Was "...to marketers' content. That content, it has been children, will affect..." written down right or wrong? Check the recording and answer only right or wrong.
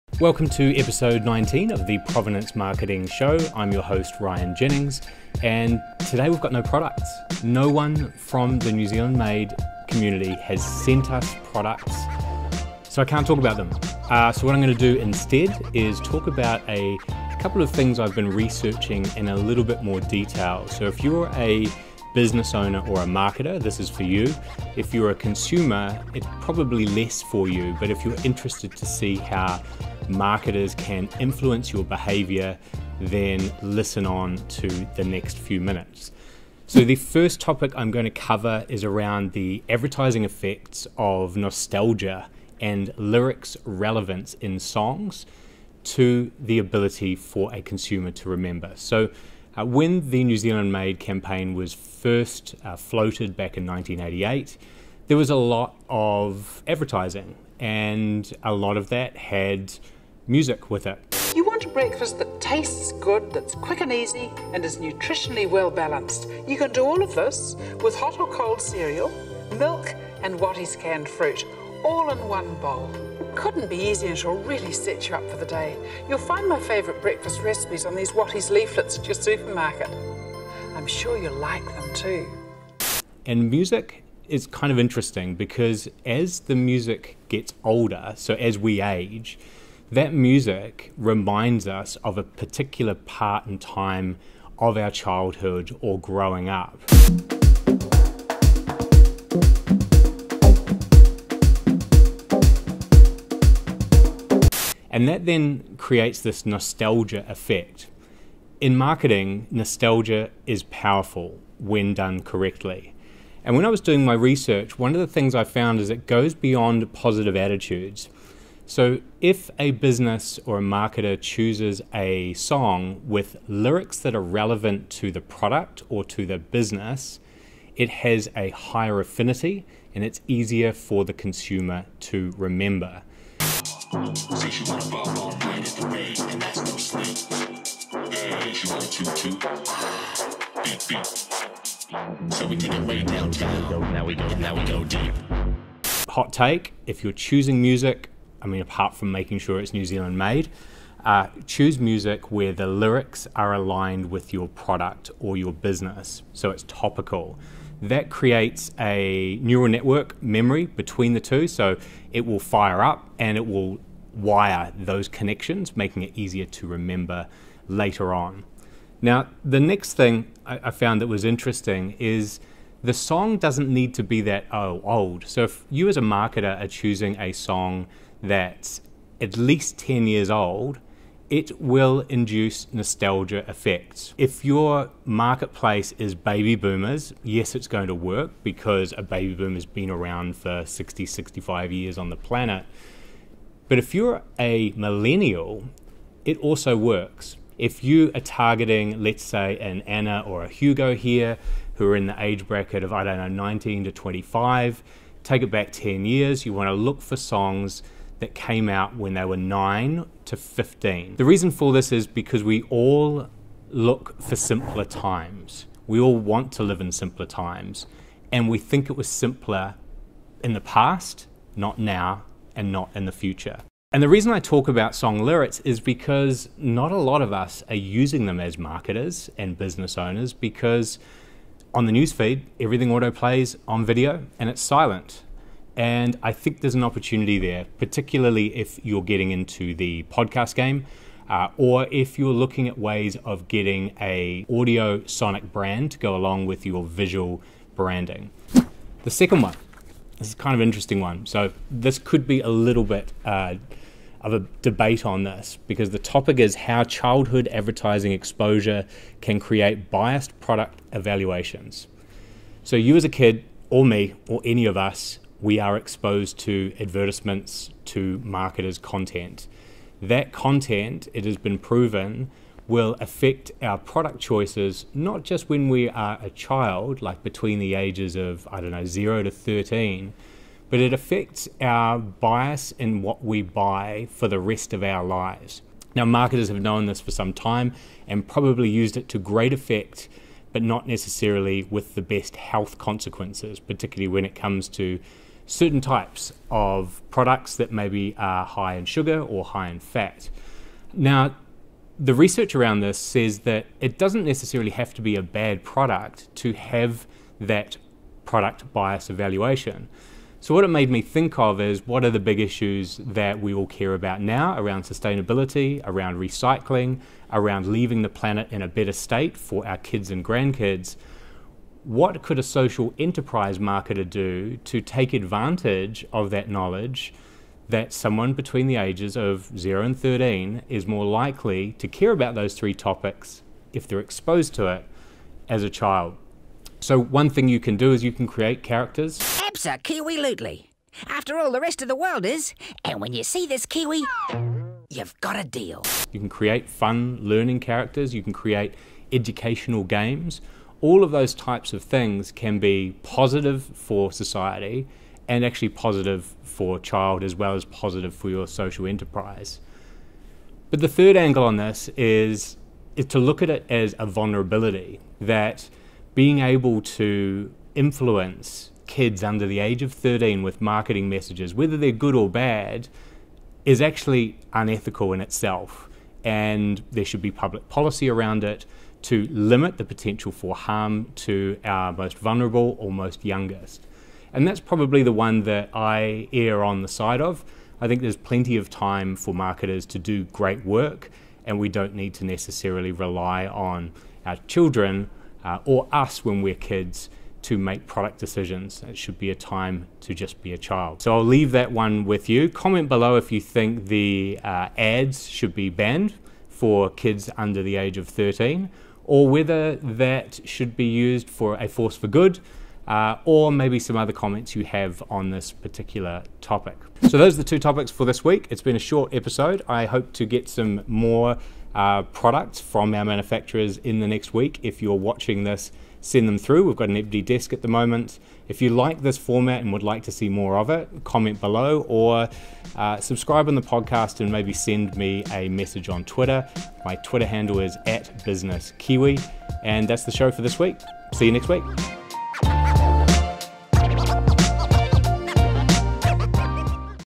wrong.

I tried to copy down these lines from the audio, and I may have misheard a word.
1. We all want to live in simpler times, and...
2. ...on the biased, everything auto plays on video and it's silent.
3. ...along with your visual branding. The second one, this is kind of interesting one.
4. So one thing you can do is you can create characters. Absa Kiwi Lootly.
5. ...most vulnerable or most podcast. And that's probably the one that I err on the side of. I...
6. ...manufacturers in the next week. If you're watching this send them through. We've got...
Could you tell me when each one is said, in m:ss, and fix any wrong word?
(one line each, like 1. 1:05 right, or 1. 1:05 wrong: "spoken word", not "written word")
1. 3:35 right
2. 3:51 wrong: "newsfeed", not "biased"
3. 4:06 right
4. 5:36 right
5. 6:21 wrong: "youngest", not "podcast"
6. 7:03 right.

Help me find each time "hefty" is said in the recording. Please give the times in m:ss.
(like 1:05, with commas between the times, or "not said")
not said.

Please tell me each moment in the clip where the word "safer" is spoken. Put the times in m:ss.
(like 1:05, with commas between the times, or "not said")
not said.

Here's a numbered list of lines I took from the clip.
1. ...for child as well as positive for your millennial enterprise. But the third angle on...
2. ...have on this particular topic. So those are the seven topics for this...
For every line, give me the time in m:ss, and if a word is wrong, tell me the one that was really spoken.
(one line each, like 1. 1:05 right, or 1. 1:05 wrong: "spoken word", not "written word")
1. 5:56 wrong: "social", not "millennial"
2. 6:54 wrong: "two", not "seven".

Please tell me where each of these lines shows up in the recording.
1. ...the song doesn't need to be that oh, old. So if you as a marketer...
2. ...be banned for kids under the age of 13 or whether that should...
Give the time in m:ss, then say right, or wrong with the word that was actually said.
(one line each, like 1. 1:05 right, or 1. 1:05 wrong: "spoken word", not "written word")
1. 2:52 right
2. 6:45 right.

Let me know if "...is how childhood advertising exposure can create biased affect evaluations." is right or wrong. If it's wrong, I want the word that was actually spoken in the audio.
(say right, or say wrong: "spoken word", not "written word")
wrong: "product", not "affect".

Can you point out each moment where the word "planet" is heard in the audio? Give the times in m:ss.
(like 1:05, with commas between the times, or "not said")
3:12, 5:18.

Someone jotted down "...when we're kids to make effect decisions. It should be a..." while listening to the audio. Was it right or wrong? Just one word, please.
wrong.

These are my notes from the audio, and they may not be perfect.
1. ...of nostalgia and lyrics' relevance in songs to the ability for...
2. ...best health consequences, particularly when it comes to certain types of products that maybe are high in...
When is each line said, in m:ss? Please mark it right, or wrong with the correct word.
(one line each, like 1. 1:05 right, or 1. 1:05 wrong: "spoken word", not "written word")
1. 0:40 right
2. 4:52 right.